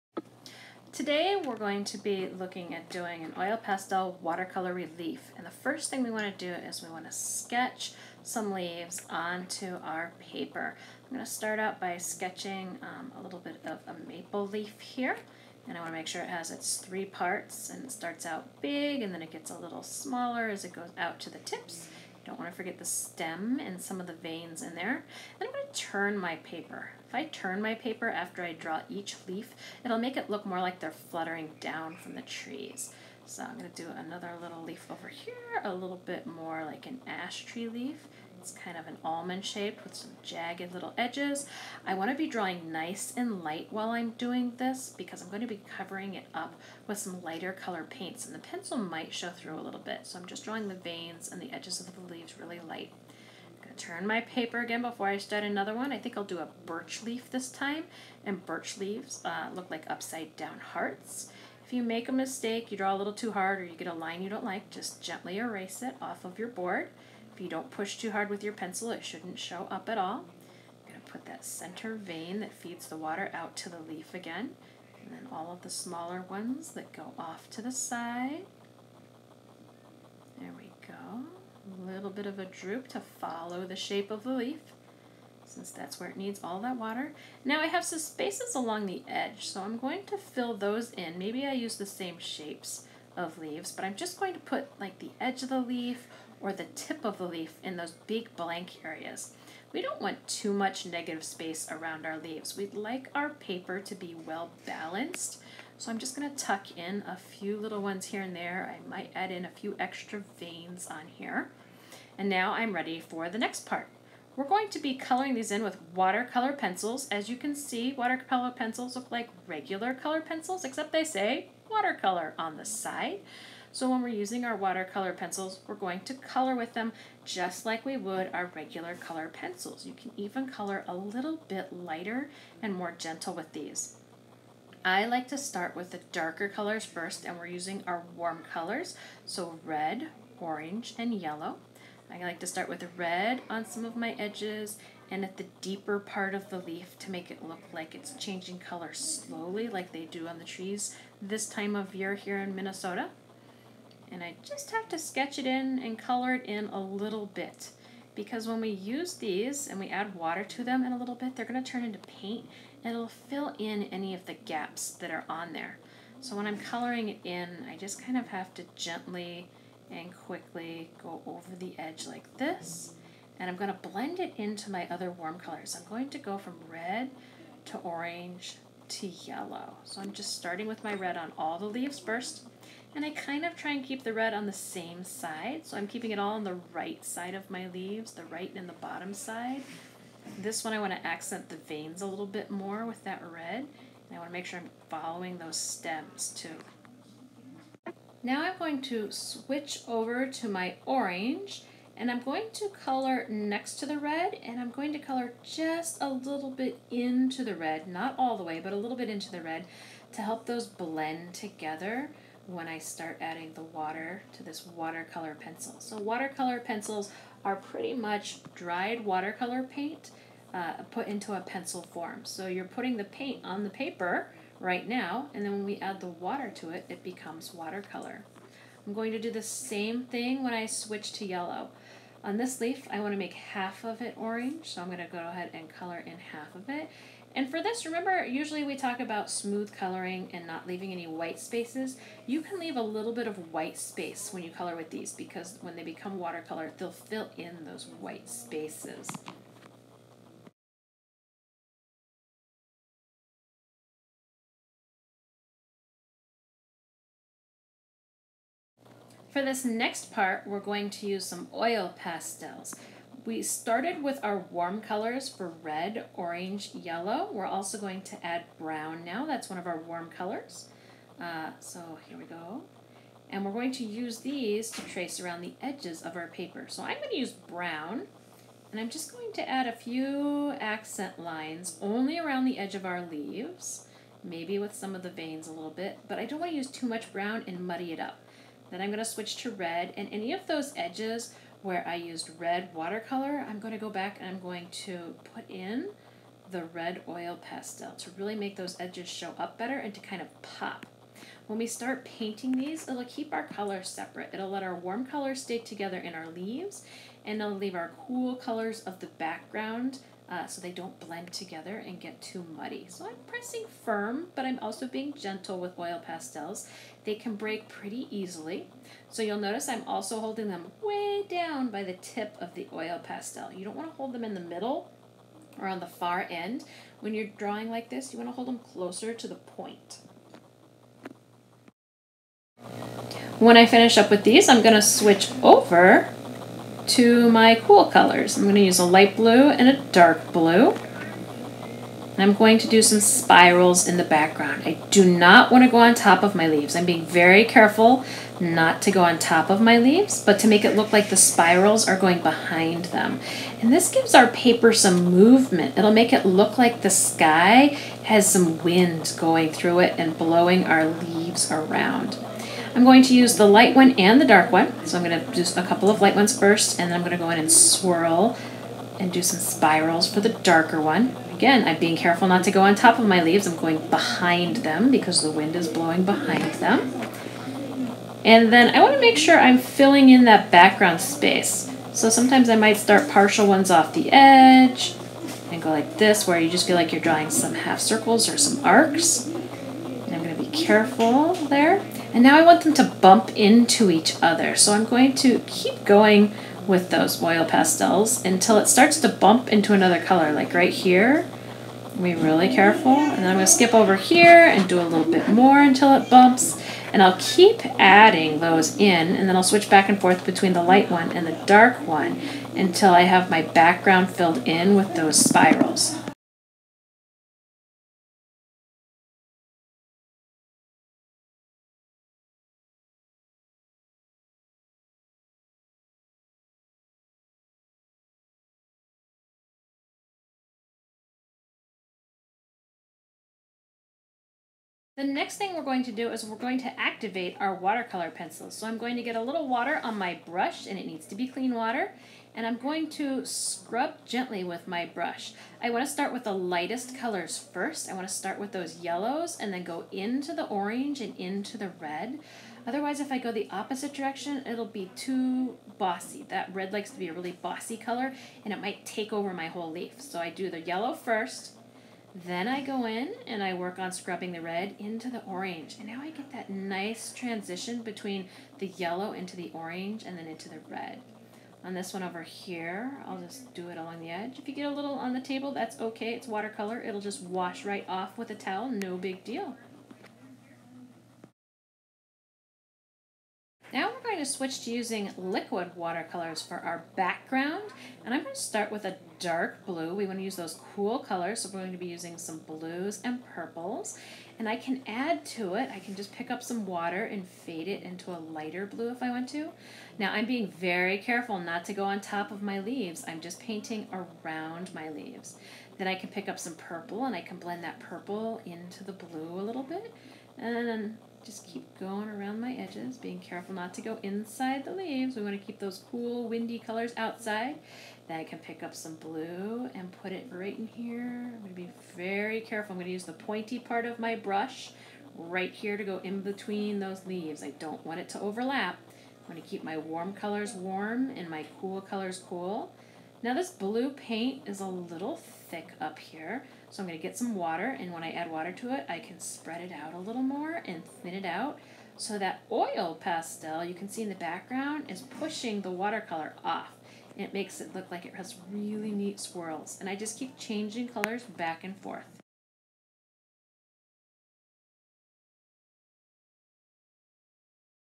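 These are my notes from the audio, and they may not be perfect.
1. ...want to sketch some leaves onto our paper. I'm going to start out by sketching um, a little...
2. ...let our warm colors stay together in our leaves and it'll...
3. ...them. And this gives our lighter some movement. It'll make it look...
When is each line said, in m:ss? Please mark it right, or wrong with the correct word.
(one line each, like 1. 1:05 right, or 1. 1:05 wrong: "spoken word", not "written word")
1. 0:06 right
2. 5:04 right
3. 5:52 wrong: "paper", not "lighter".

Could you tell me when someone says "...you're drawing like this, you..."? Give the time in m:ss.
5:27.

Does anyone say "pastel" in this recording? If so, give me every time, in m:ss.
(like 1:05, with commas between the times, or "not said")
0:03, 4:21, 4:57, 5:16, 5:23, 6:37, 9:02.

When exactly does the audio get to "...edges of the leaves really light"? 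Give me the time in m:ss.
0:51.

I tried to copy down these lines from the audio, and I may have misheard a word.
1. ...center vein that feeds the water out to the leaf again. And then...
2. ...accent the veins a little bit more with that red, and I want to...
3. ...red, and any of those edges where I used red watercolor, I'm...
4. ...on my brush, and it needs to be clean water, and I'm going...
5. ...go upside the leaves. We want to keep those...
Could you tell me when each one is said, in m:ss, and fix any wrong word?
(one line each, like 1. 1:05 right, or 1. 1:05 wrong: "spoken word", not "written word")
1. 1:11 right
2. 3:11 right
3. 4:49 right
4. 7:19 right
5. 8:33 wrong: "inside", not "upside".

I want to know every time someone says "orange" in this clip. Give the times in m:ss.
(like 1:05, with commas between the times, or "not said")
2:20, 2:57, 3:20, 3:54, 4:26, 7:30, 7:45, 7:49.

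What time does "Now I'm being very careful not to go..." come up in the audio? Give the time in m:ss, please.
8:19.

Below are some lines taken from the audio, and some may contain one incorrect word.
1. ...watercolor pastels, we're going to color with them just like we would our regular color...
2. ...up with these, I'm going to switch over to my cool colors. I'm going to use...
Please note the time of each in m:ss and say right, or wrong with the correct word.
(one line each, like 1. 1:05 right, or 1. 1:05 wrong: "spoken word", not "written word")
1. 2:04 wrong: "pencils", not "pastels"
2. 5:33 right.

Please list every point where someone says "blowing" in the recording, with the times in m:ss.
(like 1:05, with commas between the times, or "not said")
6:00, 6:15.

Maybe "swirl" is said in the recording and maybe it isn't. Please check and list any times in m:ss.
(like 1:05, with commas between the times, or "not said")
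6:07, 9:09.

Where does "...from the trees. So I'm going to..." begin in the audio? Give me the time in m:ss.
0:31.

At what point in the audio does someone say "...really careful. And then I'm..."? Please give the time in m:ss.
6:42.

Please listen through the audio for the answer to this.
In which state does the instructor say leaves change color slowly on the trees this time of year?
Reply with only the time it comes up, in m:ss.
2:32.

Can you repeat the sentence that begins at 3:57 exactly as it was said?
And for this, remember, usually we talk about smooth coloring and not leaving any white spaces.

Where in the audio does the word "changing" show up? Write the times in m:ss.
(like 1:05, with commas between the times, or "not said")
2:28, 9:10.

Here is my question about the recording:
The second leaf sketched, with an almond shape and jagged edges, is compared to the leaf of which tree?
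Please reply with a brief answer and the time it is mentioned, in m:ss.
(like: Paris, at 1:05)
Ash tree, at 0:37.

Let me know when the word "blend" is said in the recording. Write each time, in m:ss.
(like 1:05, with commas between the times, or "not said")
2:53, 3:30, 5:11, 8:27.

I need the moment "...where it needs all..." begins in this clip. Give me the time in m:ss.
1:25.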